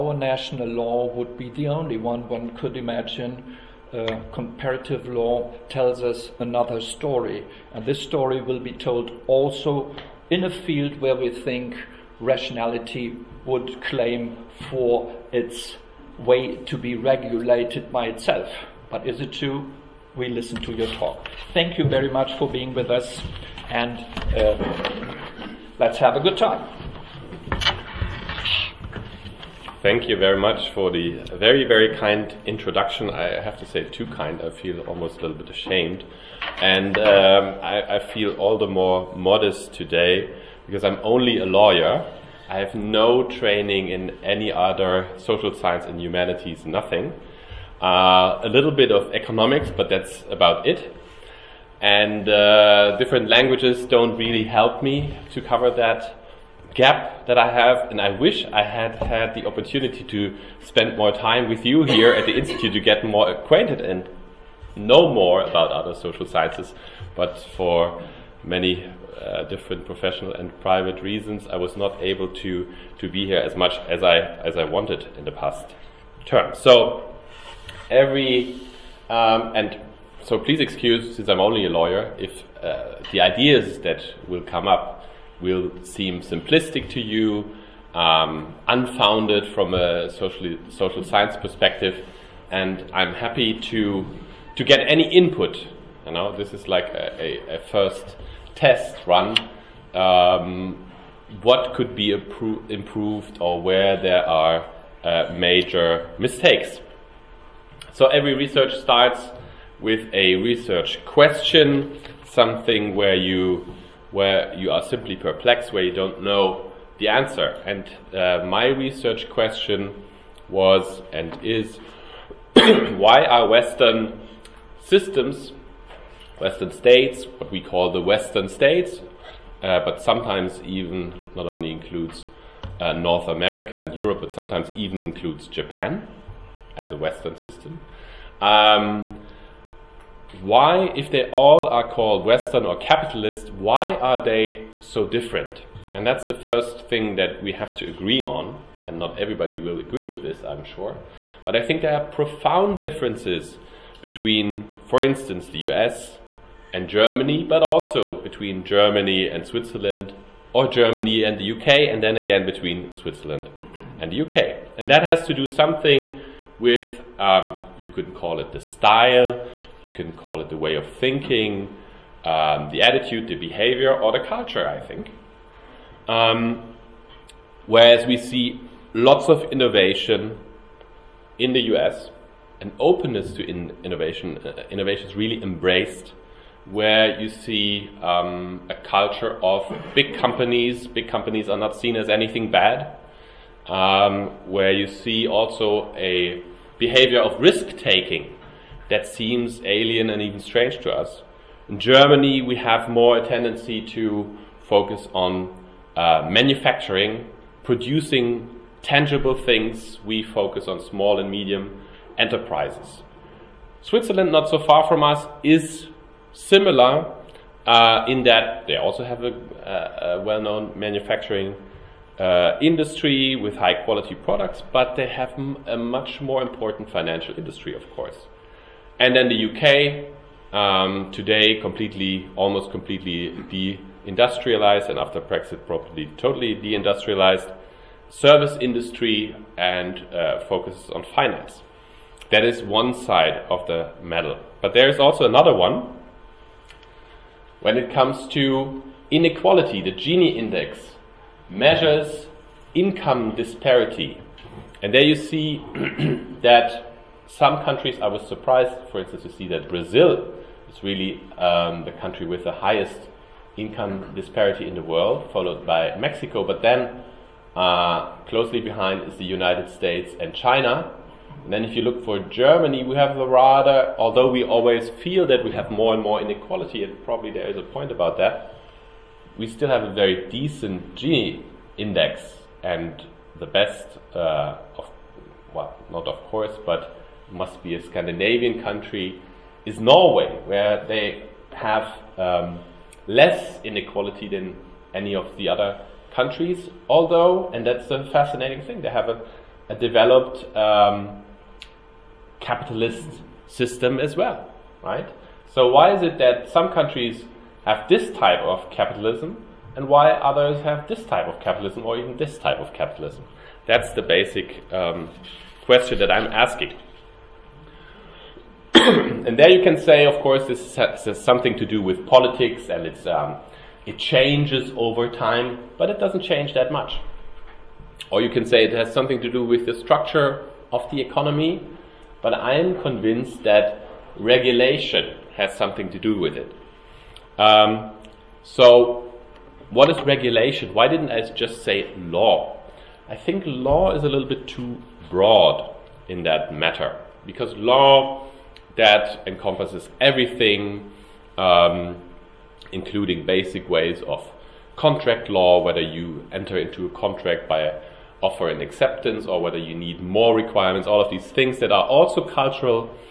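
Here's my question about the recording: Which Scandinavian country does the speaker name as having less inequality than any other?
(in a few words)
Norway.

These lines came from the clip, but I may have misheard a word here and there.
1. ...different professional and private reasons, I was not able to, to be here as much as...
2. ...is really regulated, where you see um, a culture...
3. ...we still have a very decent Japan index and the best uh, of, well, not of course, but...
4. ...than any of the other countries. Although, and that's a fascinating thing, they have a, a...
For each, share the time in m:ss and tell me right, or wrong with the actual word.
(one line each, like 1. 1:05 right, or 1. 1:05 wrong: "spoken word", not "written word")
1. 1:09 right
2. 3:05 wrong: "embraced", not "regulated"
3. 4:39 wrong: "Gini", not "Japan"
4. 4:54 right.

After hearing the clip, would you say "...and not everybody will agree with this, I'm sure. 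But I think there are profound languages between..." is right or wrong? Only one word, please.
wrong.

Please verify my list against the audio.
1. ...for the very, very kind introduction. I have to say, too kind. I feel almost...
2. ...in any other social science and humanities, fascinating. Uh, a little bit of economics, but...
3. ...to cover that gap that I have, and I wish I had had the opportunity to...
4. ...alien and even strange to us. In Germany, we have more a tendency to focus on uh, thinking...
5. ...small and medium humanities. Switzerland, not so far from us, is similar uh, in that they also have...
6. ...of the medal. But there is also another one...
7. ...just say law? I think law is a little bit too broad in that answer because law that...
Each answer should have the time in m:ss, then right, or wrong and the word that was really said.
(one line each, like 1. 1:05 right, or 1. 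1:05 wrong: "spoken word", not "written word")
1. 0:30 right
2. 0:43 wrong: "nothing", not "fascinating"
3. 0:55 right
4. 3:19 wrong: "manufacturing", not "thinking"
5. 3:30 wrong: "enterprises", not "humanities"
6. 4:03 right
7. 5:41 wrong: "matter", not "answer".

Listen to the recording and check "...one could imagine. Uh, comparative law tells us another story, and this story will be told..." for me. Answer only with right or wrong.
right.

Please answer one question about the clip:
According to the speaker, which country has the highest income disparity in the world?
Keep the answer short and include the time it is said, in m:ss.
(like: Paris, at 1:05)
Brazil, at 4:19.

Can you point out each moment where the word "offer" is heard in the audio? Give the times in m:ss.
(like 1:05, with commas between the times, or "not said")
5:58.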